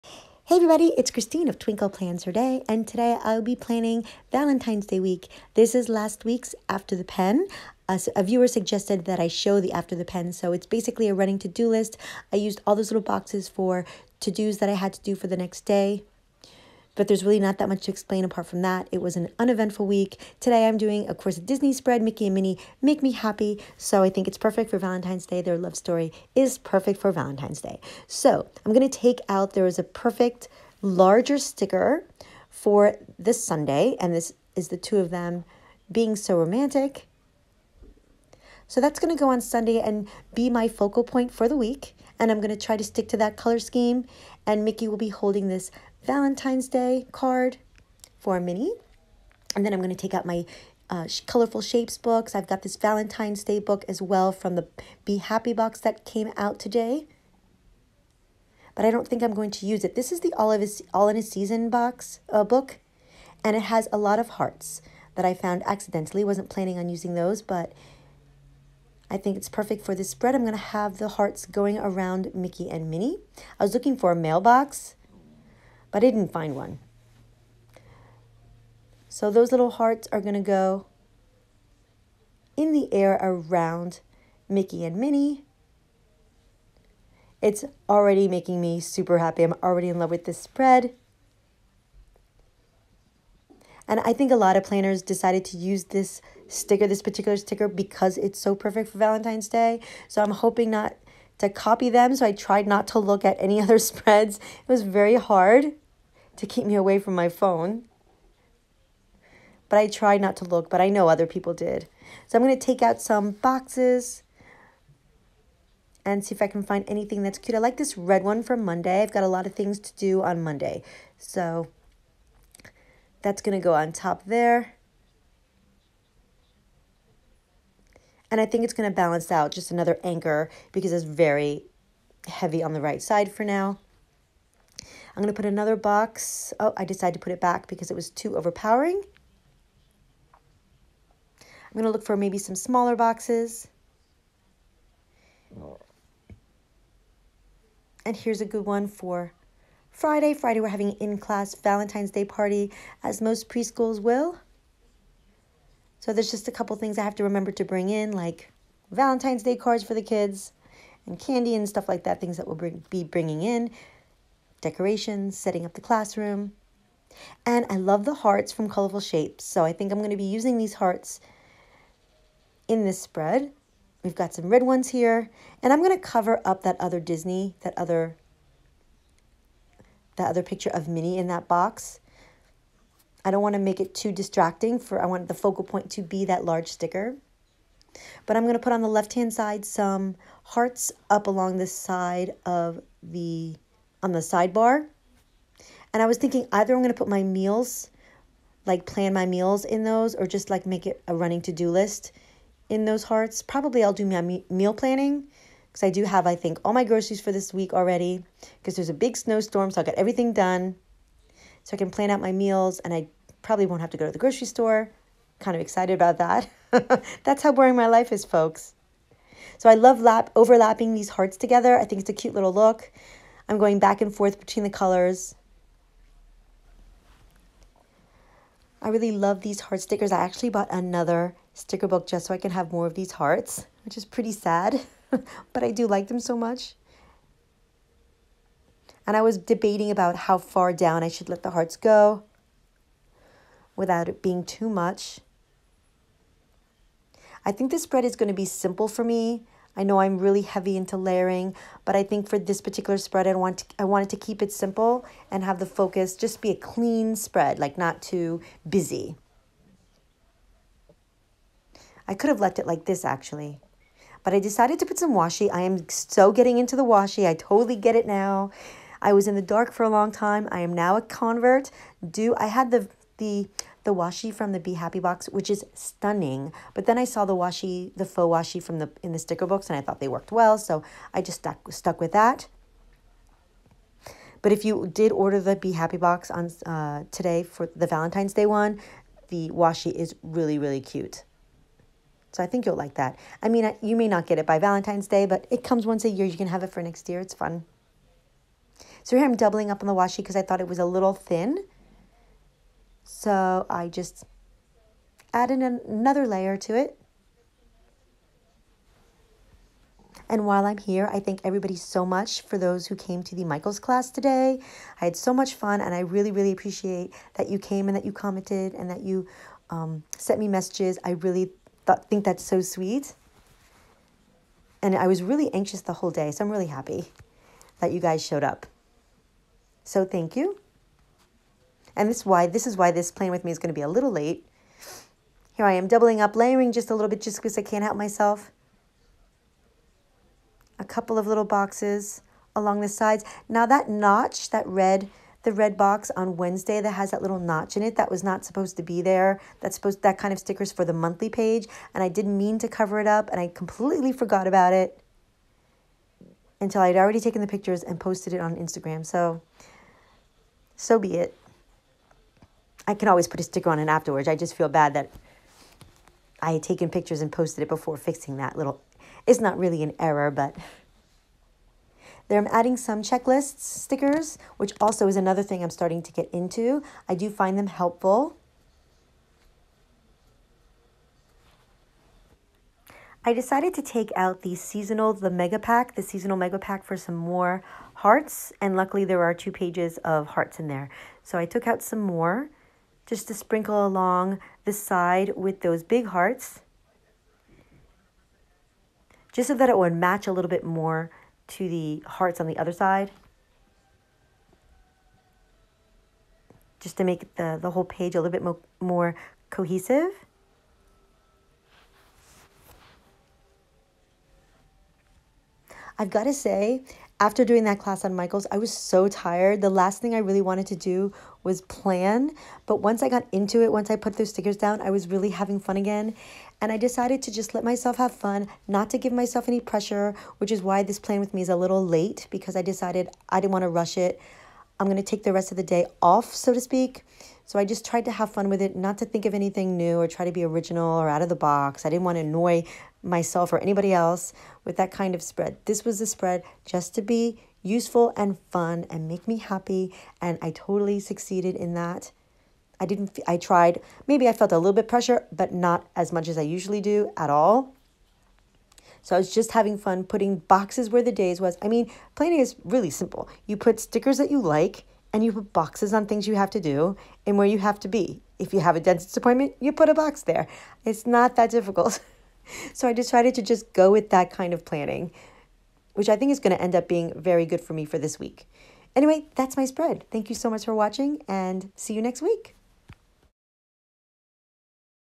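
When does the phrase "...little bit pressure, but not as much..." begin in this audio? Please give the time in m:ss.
7:34.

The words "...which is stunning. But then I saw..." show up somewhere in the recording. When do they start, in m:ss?
4:35.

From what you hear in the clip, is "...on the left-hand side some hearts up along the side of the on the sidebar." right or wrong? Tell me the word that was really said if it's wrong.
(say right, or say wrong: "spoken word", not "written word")
right.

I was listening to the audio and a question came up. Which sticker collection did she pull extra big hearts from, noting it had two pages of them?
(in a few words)
Seasonal mega pack.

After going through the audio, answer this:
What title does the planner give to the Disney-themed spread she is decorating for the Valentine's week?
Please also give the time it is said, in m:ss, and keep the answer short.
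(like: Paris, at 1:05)
Mickey and Minnie Make Me Happy, at 0:22.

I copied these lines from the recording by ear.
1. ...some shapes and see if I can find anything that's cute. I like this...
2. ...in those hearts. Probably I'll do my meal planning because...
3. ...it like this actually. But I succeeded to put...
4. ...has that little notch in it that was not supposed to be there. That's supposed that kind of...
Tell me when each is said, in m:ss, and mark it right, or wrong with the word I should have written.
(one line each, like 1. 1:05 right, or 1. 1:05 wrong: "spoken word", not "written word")
1. 1:53 wrong: "boxes", not "shapes"
2. 3:22 right
3. 4:22 wrong: "decided", not "succeeded"
4. 5:46 right.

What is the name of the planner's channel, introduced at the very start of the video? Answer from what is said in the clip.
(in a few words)
Twinkle Plans Her Day.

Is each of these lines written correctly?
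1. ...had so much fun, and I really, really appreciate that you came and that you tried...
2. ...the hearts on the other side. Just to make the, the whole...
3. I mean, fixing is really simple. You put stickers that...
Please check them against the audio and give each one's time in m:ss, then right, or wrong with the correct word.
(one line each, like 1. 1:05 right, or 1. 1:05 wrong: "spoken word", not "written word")
1. 5:15 wrong: "commented", not "tried"
2. 6:41 right
3. 7:41 wrong: "planning", not "fixing".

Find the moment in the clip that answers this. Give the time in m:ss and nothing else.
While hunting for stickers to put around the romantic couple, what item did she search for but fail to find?
1:14.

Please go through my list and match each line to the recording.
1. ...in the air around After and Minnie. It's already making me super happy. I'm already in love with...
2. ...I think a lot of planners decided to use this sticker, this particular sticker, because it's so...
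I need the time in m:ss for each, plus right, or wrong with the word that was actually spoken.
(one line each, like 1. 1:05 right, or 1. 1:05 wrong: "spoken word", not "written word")
1. 1:22 wrong: "Mickey", not "After"
2. 1:34 right.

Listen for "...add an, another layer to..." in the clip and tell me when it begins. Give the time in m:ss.
5:05.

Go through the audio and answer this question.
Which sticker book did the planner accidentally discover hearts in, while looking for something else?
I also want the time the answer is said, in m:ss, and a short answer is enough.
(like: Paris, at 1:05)
All in a Season, at 1:00.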